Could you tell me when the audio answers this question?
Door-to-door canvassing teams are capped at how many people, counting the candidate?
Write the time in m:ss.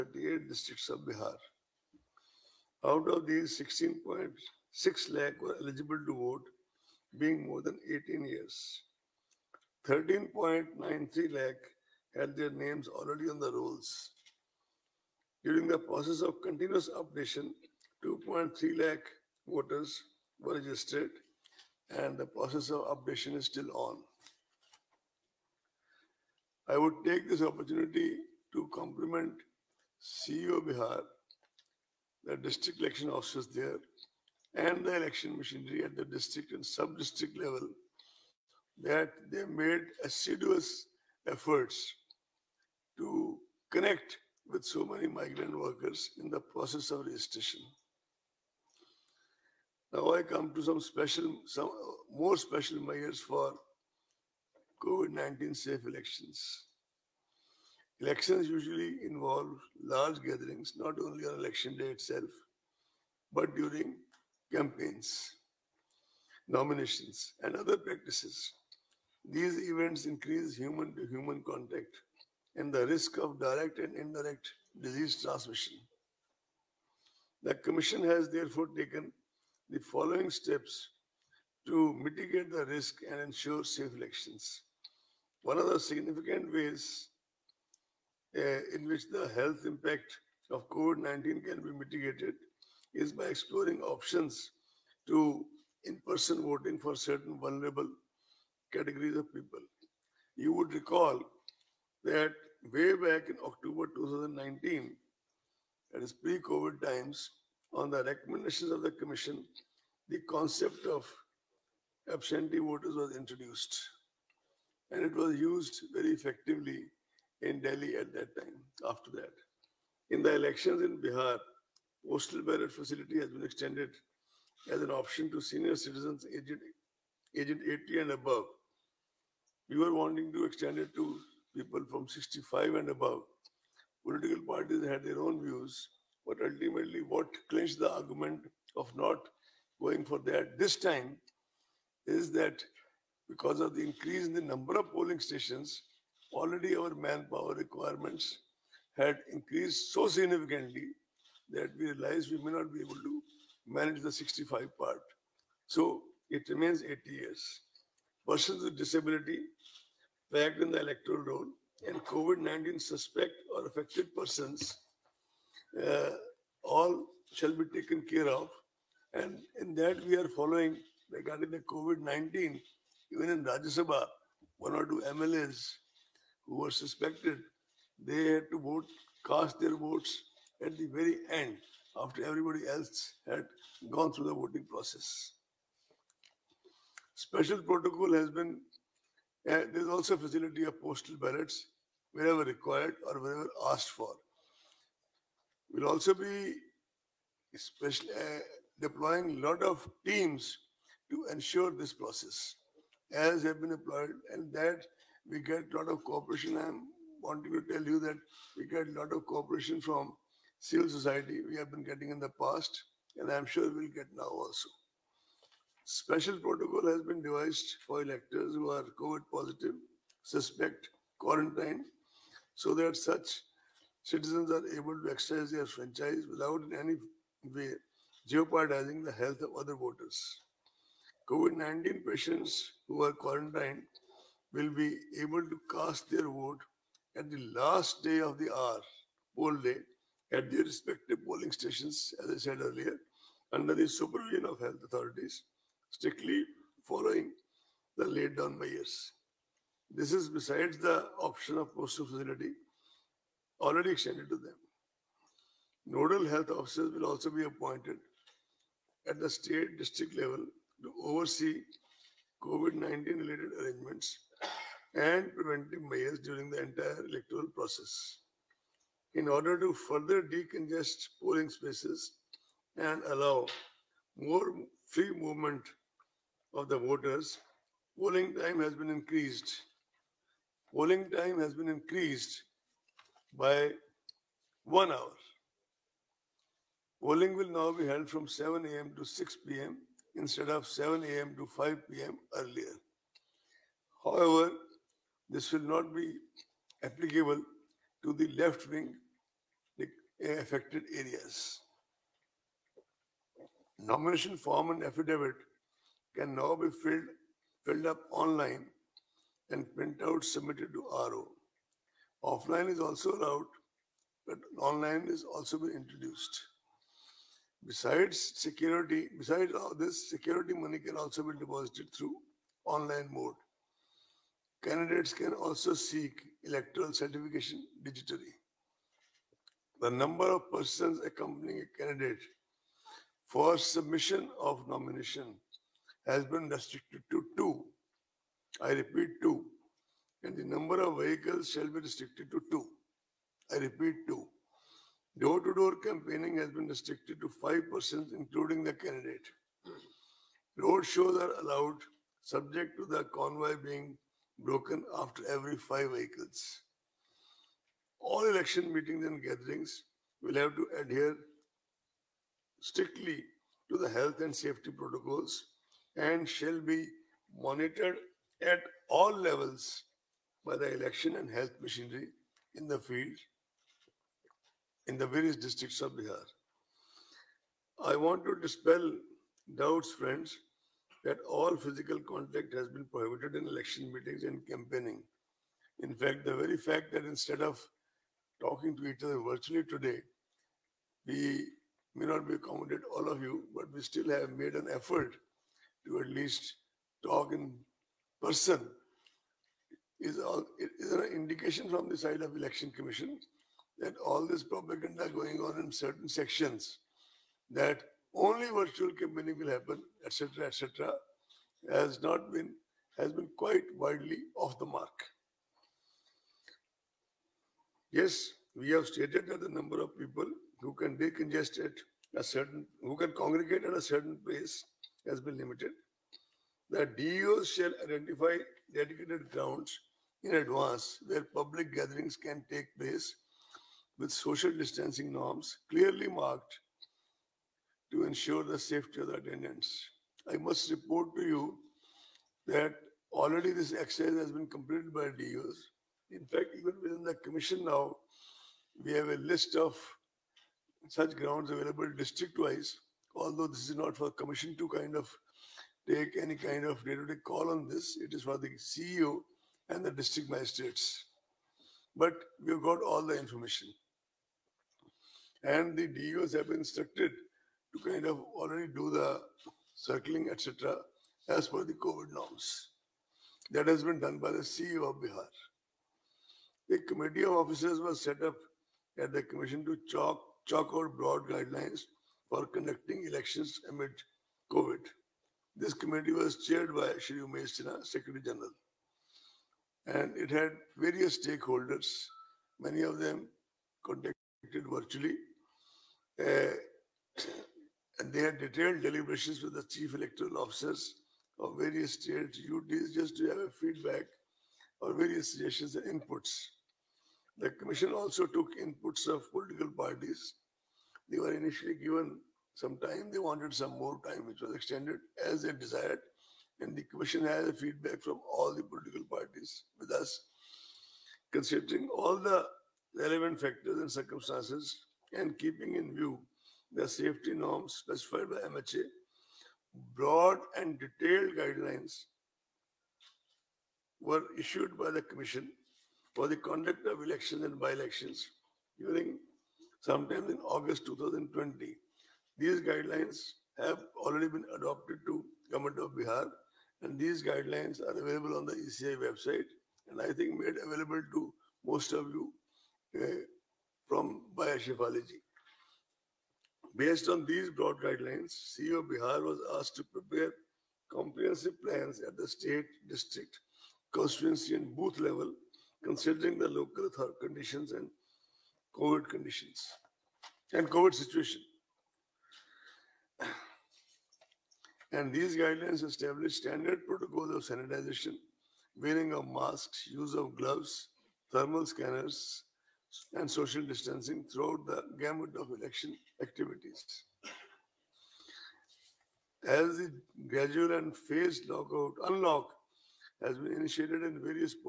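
5:47.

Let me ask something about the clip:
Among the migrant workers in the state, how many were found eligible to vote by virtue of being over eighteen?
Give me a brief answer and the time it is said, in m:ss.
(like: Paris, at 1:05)
16.6 lakh, at 0:03.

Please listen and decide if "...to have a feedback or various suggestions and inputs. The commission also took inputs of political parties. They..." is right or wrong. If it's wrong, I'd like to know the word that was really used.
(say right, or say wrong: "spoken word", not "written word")
right.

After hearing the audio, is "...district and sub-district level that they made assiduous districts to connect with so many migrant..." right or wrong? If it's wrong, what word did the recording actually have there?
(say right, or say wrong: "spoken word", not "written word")
wrong: "efforts", not "districts".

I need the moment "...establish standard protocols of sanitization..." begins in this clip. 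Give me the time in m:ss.
9:35.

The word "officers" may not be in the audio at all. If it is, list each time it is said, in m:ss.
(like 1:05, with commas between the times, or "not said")
0:33, 4:16, 7:57, 8:20.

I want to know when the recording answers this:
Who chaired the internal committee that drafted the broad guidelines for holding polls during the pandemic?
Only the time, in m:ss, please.
8:06.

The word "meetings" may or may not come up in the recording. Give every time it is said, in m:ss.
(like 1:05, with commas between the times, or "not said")
5:58, 6:23.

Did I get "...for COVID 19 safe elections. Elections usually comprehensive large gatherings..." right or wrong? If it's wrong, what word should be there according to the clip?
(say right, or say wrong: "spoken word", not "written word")
wrong: "involve", not "comprehensive".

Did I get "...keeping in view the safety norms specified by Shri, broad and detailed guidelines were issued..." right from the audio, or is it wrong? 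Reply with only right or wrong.
wrong.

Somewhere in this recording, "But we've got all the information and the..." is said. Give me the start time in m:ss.
7:41.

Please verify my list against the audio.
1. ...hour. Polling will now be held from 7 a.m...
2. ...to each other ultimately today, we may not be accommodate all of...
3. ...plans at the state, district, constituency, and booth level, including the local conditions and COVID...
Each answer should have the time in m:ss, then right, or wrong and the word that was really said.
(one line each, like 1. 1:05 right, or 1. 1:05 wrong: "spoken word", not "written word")
1. 4:44 right
2. 6:28 wrong: "virtually", not "ultimately"
3. 9:21 wrong: "considering", not "including".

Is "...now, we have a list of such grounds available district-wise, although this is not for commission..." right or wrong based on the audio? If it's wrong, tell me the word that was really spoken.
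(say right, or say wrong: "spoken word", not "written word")
right.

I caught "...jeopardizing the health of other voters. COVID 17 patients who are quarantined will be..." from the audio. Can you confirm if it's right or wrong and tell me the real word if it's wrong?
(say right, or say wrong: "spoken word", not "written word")
wrong: "19", not "17".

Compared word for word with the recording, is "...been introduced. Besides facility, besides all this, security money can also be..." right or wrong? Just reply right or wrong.
wrong.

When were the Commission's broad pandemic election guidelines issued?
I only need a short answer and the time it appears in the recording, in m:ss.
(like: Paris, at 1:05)
August 2020, at 9:00.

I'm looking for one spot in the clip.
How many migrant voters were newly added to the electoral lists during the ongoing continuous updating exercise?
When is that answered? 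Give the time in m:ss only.
0:18.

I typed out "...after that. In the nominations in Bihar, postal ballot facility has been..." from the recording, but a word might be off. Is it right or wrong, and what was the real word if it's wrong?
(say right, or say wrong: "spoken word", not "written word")
wrong: "elections", not "nominations".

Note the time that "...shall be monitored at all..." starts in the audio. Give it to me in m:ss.
6:06.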